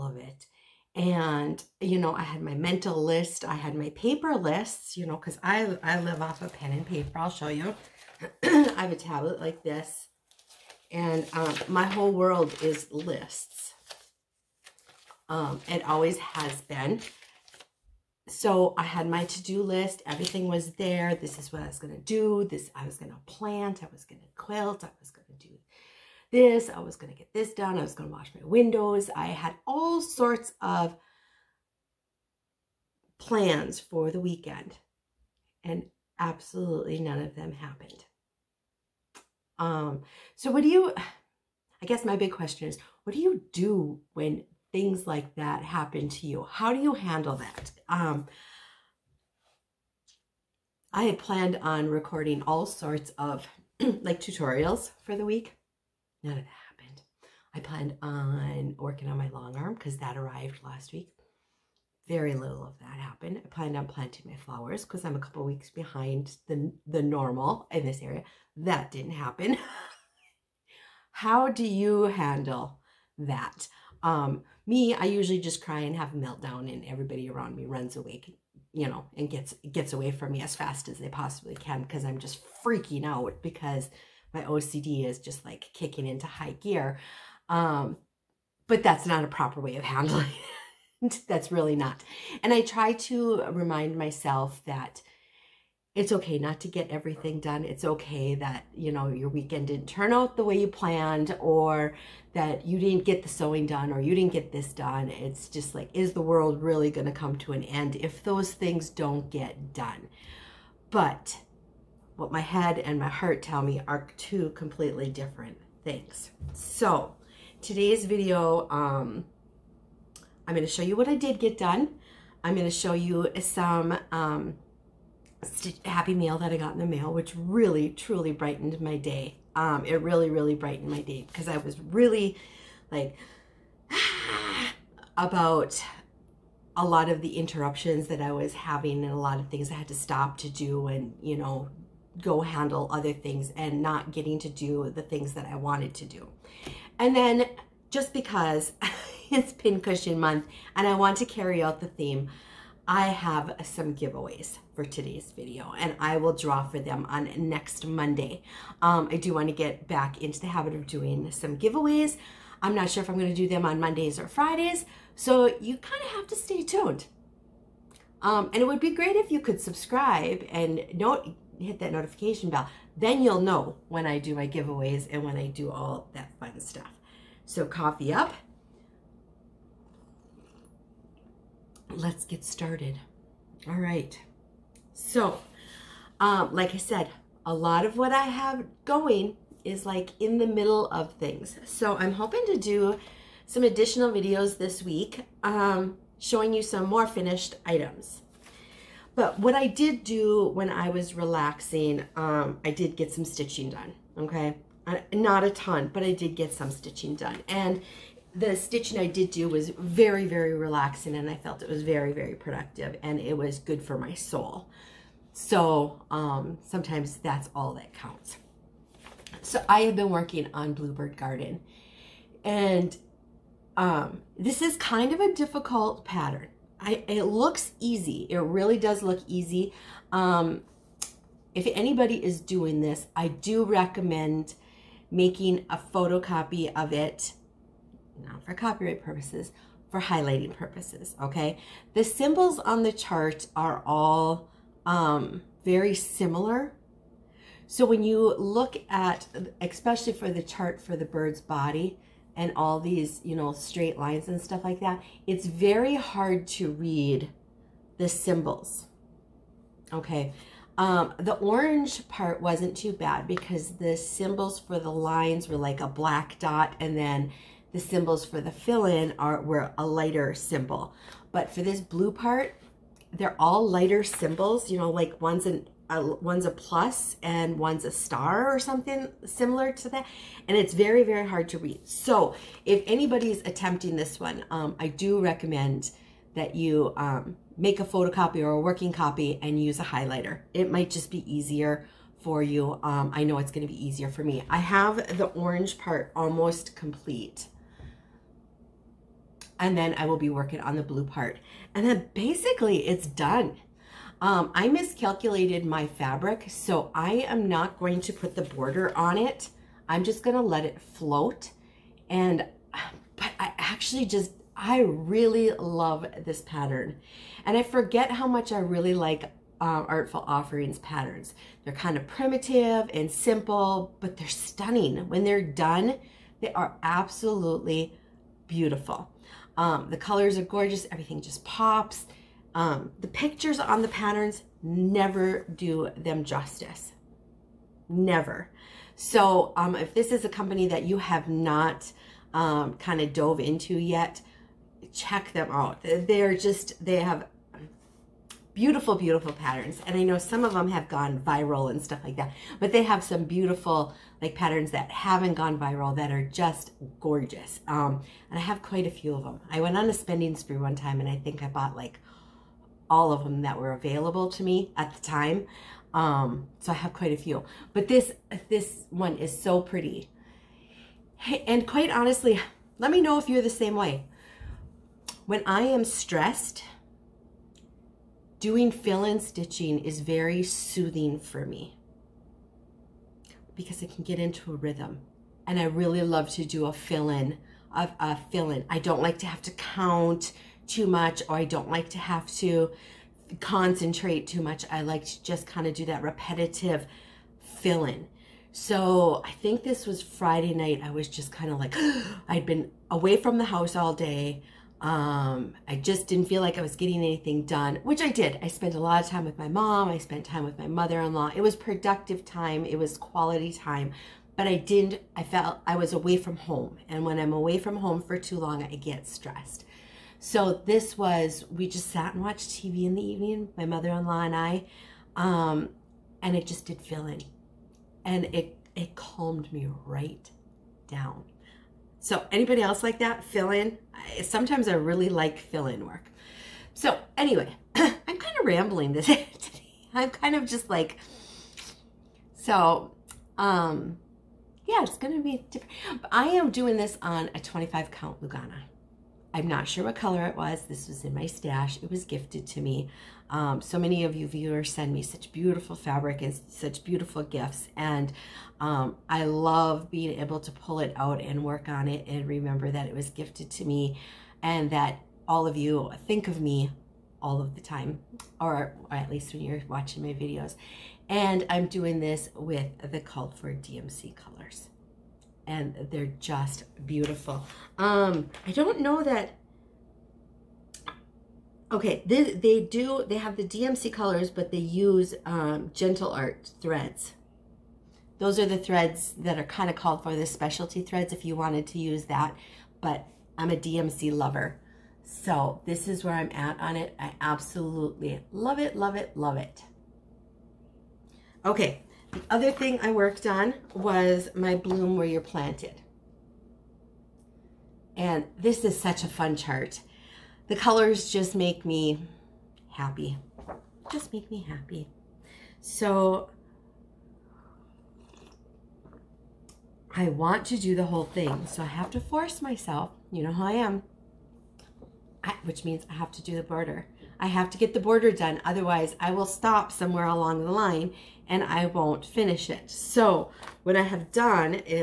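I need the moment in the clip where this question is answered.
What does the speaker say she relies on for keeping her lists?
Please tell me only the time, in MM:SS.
00:06.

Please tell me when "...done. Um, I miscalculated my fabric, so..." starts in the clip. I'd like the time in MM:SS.
05:03.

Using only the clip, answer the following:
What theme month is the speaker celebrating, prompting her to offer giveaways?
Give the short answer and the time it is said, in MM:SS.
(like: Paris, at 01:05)
Pincushion Month, at 02:29.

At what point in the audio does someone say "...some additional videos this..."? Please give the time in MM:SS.
03:13.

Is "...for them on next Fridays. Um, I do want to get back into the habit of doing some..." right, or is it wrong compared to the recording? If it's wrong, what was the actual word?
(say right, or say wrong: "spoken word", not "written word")
wrong: "Monday", not "Fridays".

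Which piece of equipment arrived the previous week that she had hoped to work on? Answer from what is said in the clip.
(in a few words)
Long arm.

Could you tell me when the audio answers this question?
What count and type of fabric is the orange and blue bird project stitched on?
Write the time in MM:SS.
07:27.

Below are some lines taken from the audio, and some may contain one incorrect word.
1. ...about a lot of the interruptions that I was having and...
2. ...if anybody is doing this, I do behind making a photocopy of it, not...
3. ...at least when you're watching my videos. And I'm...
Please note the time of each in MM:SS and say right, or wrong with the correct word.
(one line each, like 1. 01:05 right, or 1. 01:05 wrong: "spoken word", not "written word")
1. 02:15 right
2. 03:51 wrong: "recommend", not "behind"
3. 07:48 right.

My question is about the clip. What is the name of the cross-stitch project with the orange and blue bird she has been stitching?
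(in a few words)
Bluebird Garden.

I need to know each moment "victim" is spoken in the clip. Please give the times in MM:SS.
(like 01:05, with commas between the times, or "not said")
not said.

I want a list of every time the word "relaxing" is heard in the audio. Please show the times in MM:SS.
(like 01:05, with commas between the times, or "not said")
03:21, 03:30.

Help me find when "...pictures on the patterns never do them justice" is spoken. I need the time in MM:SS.
05:33.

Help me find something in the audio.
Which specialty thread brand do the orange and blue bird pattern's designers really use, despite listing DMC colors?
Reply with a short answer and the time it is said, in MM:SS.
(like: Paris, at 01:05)
Gentle Art, at 08:05.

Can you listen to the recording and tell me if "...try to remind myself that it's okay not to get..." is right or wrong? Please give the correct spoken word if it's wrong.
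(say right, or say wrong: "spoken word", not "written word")
right.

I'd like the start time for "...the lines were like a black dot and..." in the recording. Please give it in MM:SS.
04:24.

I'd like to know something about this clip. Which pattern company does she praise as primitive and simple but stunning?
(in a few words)
Artful Offerings.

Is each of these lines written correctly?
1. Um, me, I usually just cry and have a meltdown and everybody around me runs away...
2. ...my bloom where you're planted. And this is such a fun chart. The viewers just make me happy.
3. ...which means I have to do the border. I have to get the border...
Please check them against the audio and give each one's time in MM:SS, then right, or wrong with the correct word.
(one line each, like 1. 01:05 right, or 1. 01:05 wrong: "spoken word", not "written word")
1. 01:14 right
2. 08:24 wrong: "colors", not "viewers"
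3. 08:45 right.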